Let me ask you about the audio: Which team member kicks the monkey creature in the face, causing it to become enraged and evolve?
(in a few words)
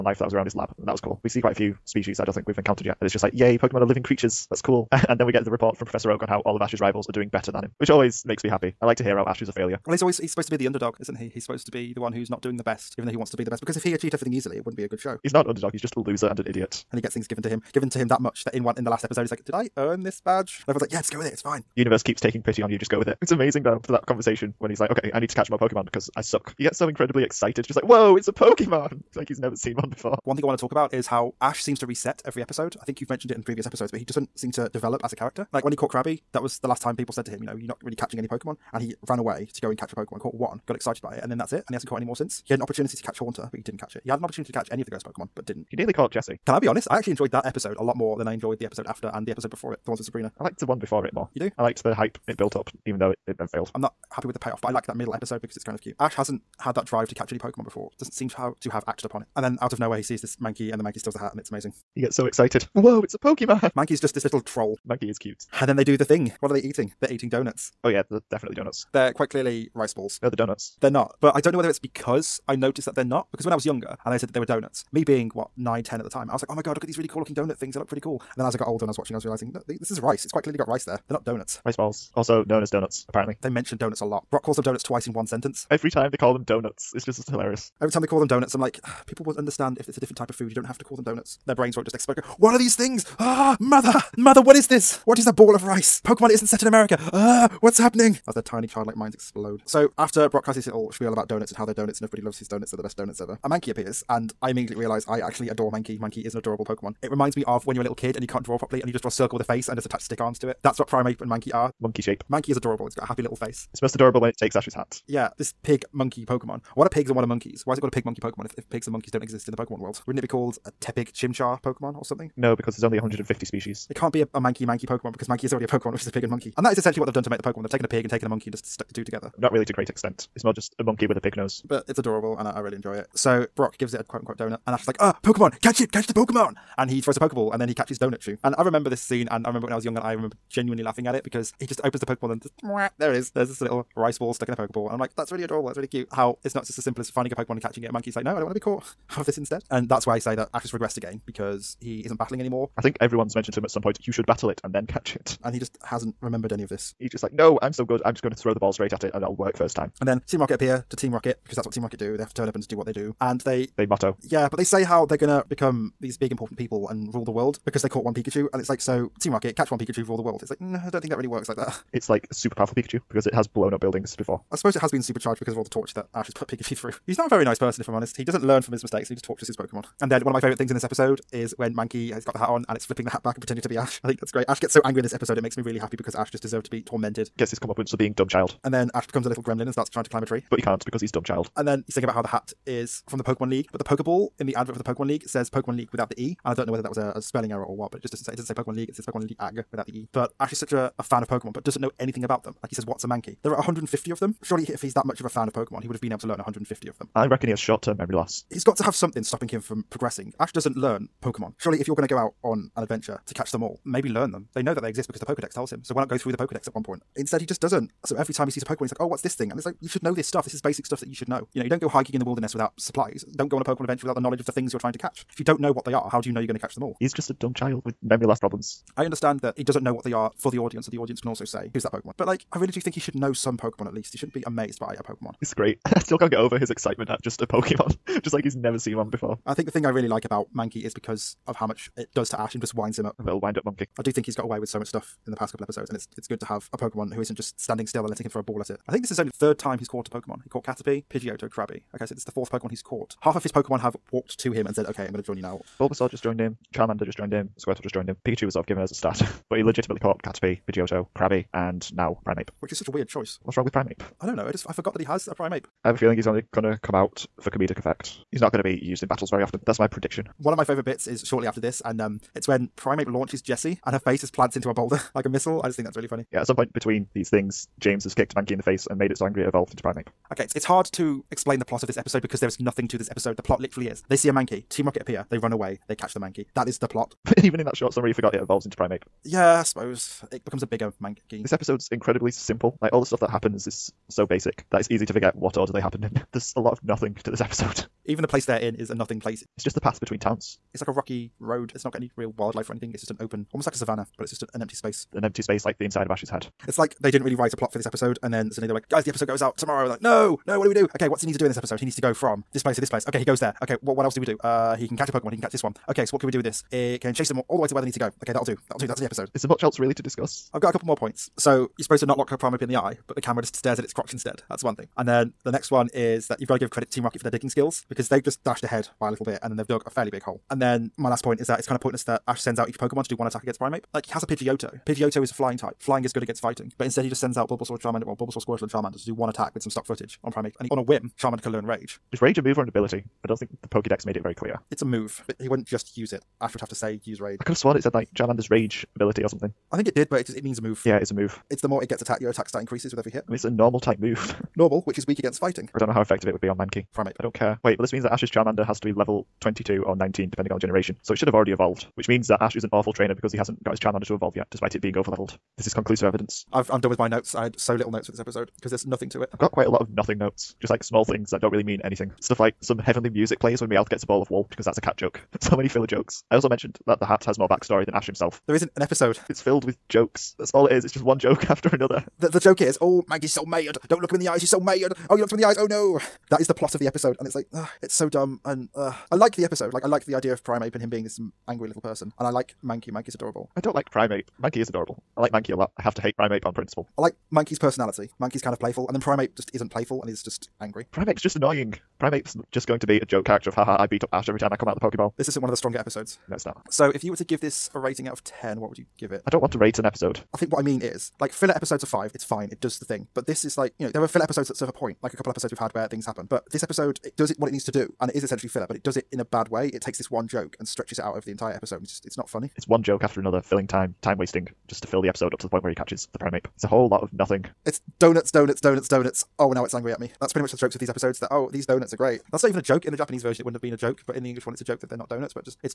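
James.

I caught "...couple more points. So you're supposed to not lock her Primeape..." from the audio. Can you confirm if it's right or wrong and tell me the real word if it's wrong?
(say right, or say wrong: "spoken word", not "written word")
right.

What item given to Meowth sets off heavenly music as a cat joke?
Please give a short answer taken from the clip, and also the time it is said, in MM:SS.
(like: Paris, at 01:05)
ball of wool, at 06:14.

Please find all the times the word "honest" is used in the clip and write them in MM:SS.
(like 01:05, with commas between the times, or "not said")
00:46, 02:57.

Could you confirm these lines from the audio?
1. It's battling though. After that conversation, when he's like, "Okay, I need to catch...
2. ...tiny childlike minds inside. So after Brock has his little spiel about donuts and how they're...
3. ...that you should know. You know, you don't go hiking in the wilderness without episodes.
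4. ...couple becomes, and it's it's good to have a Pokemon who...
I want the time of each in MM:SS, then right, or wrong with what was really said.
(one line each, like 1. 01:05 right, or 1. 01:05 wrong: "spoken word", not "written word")
1. 00:23 wrong: "amazing", not "battling"
2. 01:38 wrong: "explode", not "inside"
3. 03:41 wrong: "supplies", not "episodes"
4. 04:05 wrong: "episodes", not "becomes".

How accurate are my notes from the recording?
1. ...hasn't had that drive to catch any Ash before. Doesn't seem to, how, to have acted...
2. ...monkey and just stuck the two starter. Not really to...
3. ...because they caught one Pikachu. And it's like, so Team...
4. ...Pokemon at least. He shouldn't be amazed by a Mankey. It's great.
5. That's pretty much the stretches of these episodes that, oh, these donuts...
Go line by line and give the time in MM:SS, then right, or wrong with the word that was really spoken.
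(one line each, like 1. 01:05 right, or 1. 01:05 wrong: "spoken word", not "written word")
1. 00:56 wrong: "Pokemon", not "Ash"
2. 02:08 wrong: "together", not "starter"
3. 02:47 right
4. 03:53 wrong: "Pokemon", not "Mankey"
5. 07:10 wrong: "jokes", not "stretches".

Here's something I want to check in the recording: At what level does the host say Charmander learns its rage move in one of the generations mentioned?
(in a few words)
22 or 19.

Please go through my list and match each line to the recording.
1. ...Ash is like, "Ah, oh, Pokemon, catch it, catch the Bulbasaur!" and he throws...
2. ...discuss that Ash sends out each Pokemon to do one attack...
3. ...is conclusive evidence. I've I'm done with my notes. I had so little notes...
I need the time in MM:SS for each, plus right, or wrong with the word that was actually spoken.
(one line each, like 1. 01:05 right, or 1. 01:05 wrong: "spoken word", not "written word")
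1. 02:14 wrong: "Pokemon", not "Bulbasaur"
2. 05:31 wrong: "pointless", not "discuss"
3. 06:05 right.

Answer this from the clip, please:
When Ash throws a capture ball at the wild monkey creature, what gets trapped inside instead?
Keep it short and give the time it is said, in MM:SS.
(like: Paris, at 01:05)
rice ball, at 02:23.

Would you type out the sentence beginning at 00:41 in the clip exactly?
And he hasn't caught any more since.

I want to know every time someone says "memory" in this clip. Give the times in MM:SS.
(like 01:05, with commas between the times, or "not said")
03:27, 03:48.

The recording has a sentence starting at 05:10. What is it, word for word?
Okay, what's he need to do in this episode?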